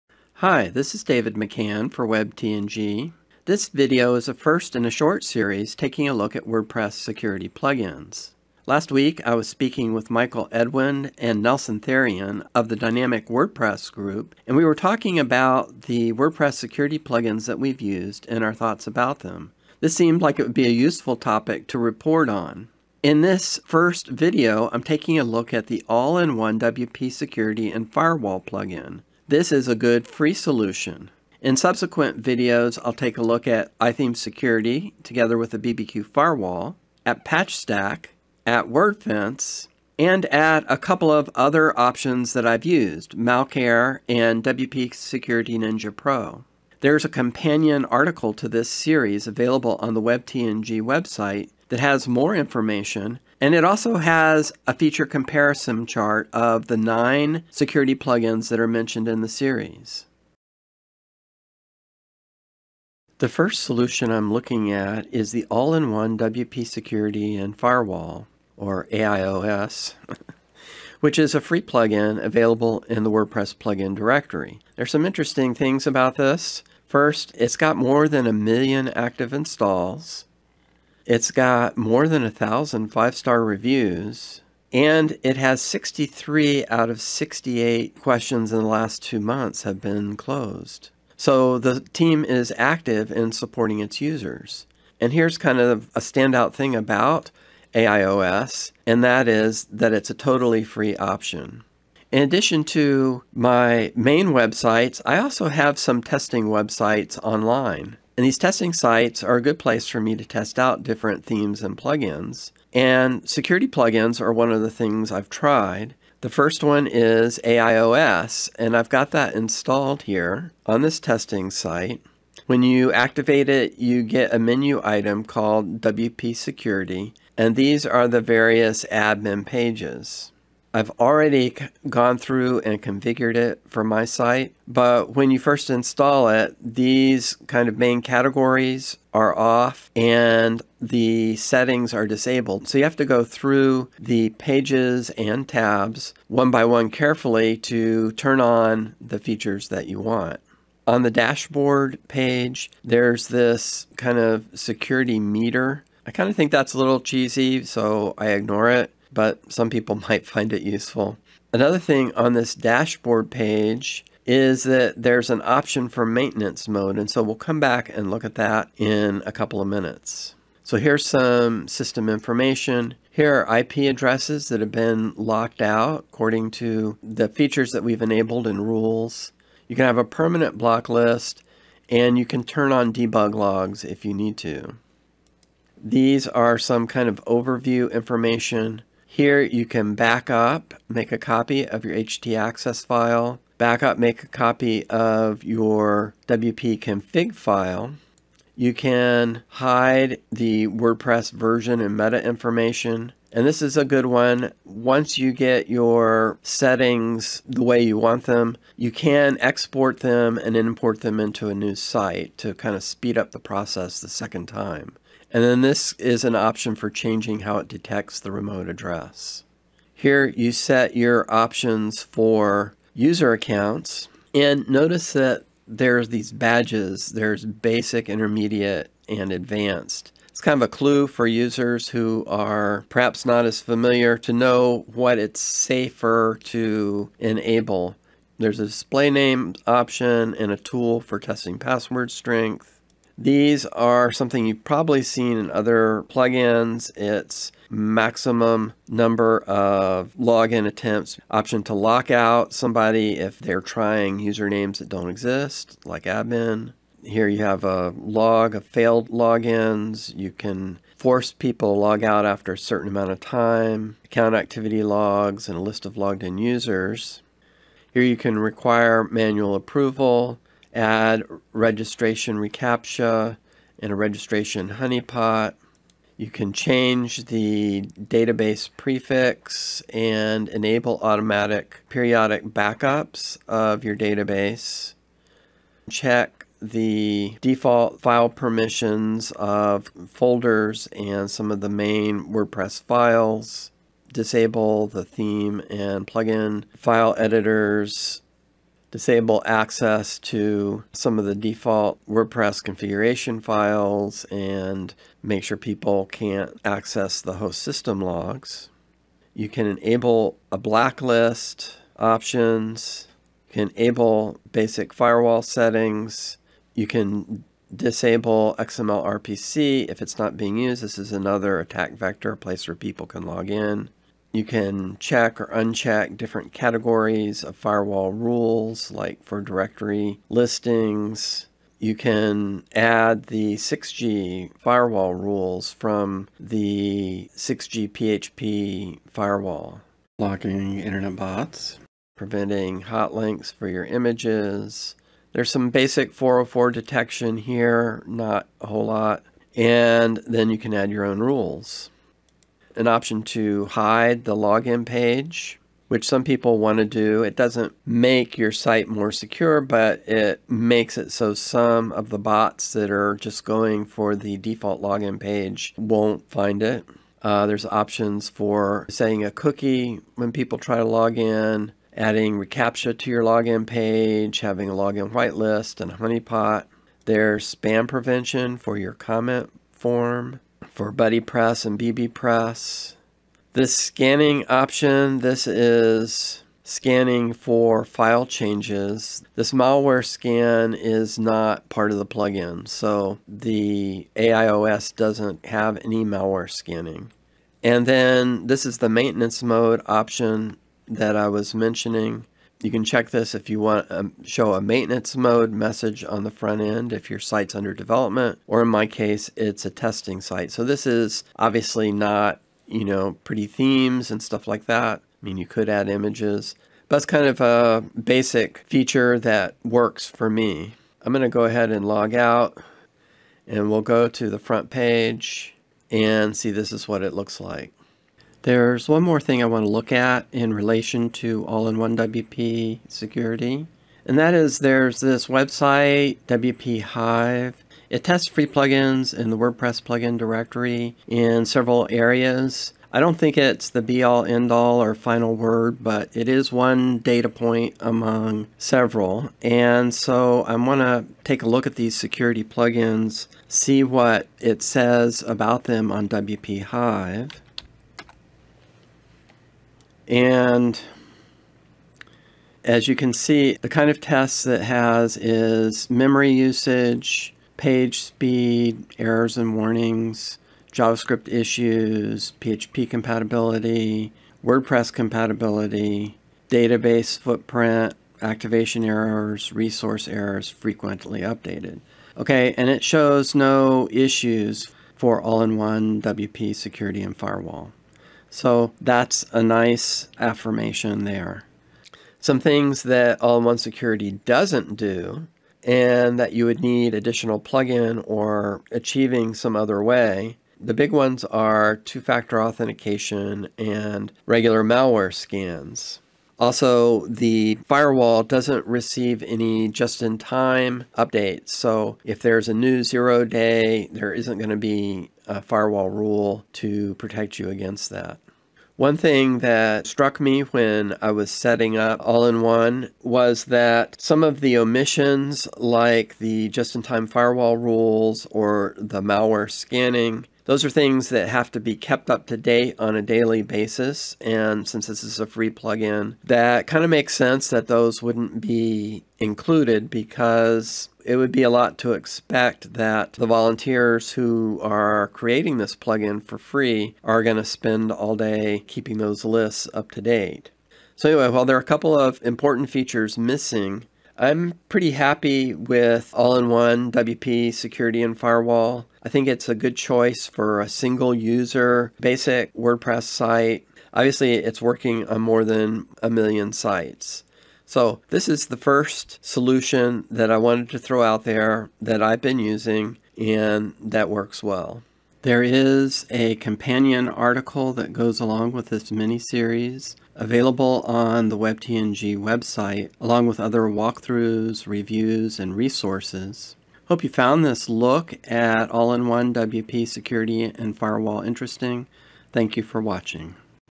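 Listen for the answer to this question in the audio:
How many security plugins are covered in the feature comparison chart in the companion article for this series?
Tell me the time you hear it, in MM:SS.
00:56.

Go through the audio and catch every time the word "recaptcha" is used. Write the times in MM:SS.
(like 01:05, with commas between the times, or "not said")
04:32, 06:12.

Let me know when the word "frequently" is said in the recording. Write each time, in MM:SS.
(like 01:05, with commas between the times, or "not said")
08:00.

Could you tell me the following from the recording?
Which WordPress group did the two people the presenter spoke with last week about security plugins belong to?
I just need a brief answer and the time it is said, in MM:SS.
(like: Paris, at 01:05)
Dynamic WordPress group, at 00:12.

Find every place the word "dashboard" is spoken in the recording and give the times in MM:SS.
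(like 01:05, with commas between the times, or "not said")
02:31, 02:42.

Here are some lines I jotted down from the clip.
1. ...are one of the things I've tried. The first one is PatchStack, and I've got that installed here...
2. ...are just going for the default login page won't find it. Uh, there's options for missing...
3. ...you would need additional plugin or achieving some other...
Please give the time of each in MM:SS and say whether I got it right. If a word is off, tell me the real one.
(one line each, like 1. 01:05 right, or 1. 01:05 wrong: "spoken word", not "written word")
1. 01:54 wrong: "AIOS", not "PatchStack"
2. 06:02 wrong: "setting", not "missing"
3. 08:16 right.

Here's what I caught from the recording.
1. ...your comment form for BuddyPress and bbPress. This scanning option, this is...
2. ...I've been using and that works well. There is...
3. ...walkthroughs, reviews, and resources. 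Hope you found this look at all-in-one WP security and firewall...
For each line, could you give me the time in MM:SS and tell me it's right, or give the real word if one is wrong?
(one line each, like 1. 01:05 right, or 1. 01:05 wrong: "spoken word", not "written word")
1. 06:18 right
2. 09:32 right
3. 09:43 right.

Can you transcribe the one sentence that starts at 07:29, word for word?
And so I want to take a look at these security plugins, see what it says about them on WP Hive.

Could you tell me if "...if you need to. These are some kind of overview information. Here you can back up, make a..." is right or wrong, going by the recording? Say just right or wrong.
right.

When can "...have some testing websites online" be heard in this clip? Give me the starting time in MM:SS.
01:45.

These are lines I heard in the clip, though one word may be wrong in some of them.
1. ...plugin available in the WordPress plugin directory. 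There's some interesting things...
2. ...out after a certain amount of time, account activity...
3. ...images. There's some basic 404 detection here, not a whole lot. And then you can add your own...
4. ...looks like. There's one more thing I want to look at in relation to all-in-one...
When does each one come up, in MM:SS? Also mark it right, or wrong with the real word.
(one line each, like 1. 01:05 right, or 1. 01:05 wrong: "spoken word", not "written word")
1. 01:11 right
2. 04:22 right
3. 05:43 right
4. 07:07 right.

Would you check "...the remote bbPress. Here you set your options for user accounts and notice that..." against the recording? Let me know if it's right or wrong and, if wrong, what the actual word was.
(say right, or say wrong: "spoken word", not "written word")
wrong: "address", not "bbPress".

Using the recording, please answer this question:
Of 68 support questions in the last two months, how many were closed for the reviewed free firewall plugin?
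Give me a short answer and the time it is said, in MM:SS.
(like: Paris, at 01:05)
63, at 01:25.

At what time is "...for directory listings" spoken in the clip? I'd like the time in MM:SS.
05:29.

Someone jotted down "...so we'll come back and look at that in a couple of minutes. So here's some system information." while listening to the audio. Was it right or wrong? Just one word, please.
right.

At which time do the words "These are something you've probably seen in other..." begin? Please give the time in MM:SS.
04:03.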